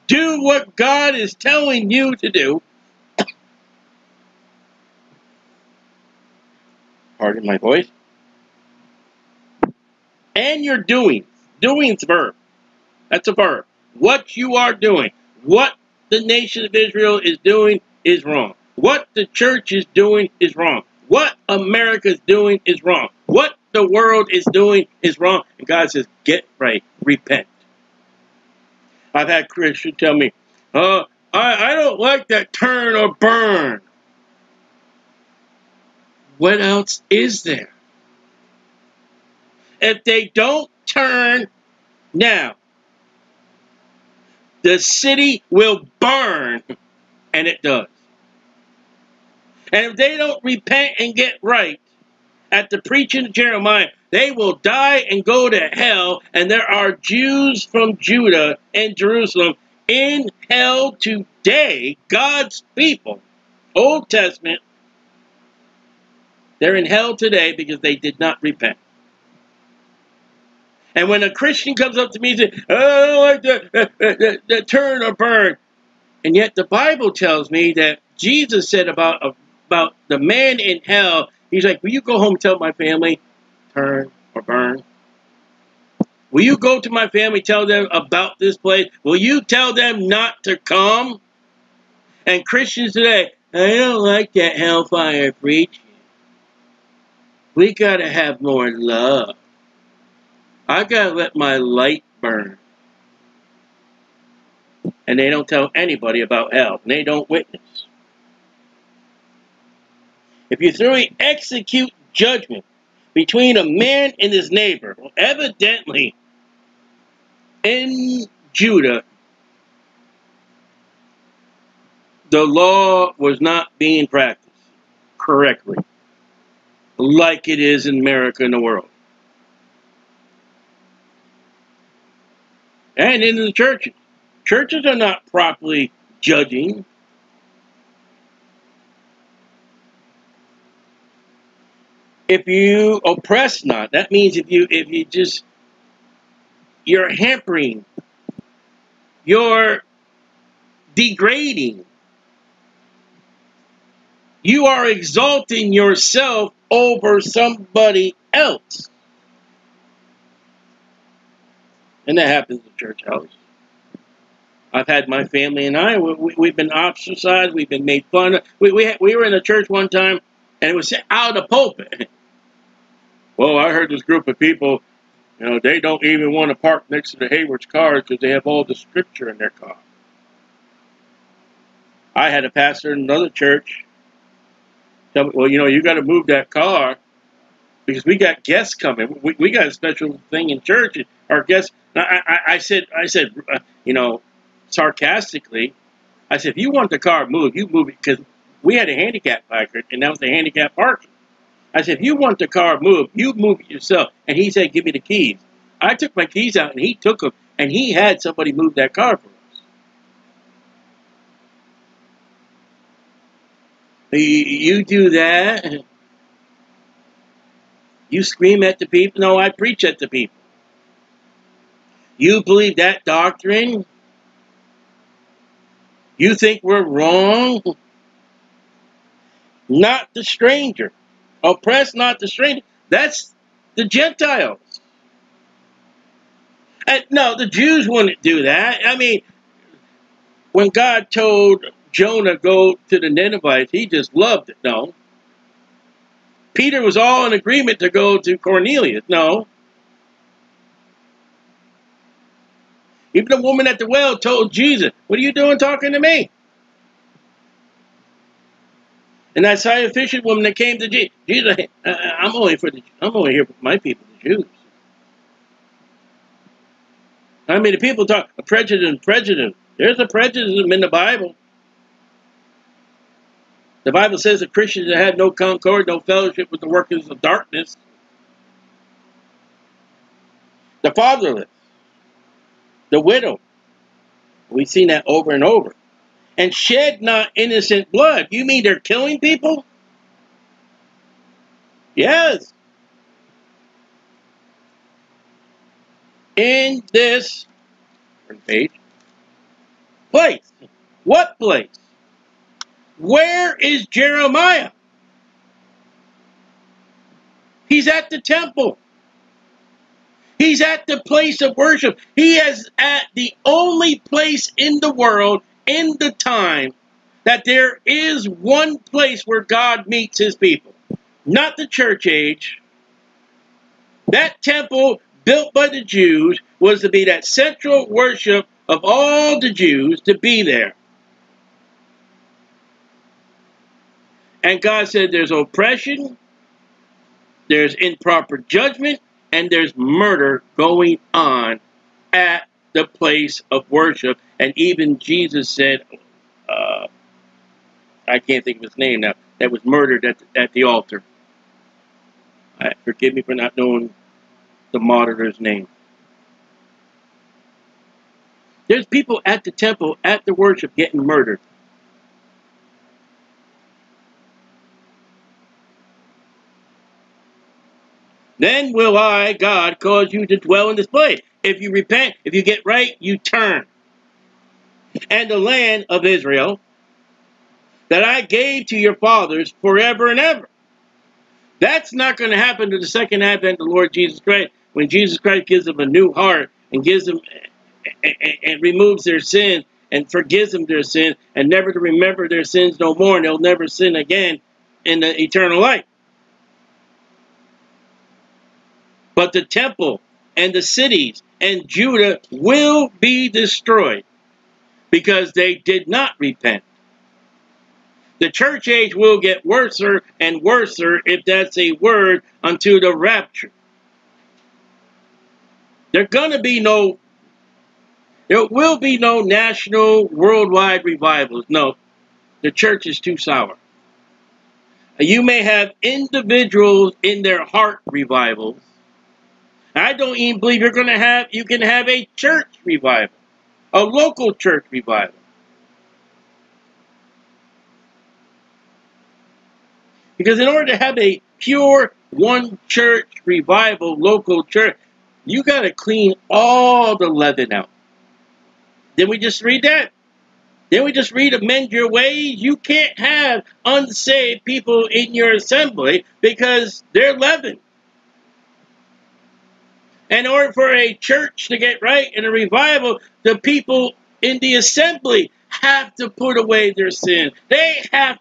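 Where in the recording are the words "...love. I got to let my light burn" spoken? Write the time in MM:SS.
01:38.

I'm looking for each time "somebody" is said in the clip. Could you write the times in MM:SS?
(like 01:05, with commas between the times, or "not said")
02:37, 03:28.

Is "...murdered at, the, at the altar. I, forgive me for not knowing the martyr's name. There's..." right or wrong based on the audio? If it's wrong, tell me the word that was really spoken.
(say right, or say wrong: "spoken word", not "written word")
right.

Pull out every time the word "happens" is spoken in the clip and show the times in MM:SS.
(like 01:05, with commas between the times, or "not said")
02:42, 06:22.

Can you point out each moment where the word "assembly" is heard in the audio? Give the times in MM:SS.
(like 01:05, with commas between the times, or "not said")
07:35, 07:44.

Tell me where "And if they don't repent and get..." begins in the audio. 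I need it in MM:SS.
00:49.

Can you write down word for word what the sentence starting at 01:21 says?
He's like, Will you go home and tell my family, turn or burn?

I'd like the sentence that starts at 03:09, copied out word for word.
We, we got a special thing in church.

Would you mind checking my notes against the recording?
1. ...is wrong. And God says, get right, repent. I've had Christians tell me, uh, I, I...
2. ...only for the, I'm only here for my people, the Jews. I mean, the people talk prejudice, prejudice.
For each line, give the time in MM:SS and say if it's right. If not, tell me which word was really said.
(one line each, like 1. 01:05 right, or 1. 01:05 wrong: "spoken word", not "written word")
1. 00:25 right
2. 04:22 right.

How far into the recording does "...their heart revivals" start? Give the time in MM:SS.
07:07.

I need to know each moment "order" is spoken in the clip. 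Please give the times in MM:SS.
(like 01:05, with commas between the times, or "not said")
07:20, 07:40.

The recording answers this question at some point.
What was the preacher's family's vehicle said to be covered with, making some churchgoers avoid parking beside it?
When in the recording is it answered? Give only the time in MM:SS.
02:58.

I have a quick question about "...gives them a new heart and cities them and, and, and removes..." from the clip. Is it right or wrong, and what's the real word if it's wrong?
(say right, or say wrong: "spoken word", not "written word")
wrong: "gives", not "cities".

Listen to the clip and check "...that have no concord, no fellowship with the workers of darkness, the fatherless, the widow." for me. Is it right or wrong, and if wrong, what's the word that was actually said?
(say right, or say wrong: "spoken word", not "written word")
right.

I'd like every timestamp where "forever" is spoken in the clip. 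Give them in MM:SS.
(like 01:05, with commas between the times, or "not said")
06:19.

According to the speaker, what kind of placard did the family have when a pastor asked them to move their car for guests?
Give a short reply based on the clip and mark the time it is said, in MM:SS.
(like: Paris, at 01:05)
Handicap placard, at 03:18.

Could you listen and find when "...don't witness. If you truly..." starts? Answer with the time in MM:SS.
01:47.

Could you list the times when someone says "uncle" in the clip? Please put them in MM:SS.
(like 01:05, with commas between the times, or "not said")
not said.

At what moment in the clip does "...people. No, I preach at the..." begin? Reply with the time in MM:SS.
03:38.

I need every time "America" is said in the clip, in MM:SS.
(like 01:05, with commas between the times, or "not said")
00:21, 02:08.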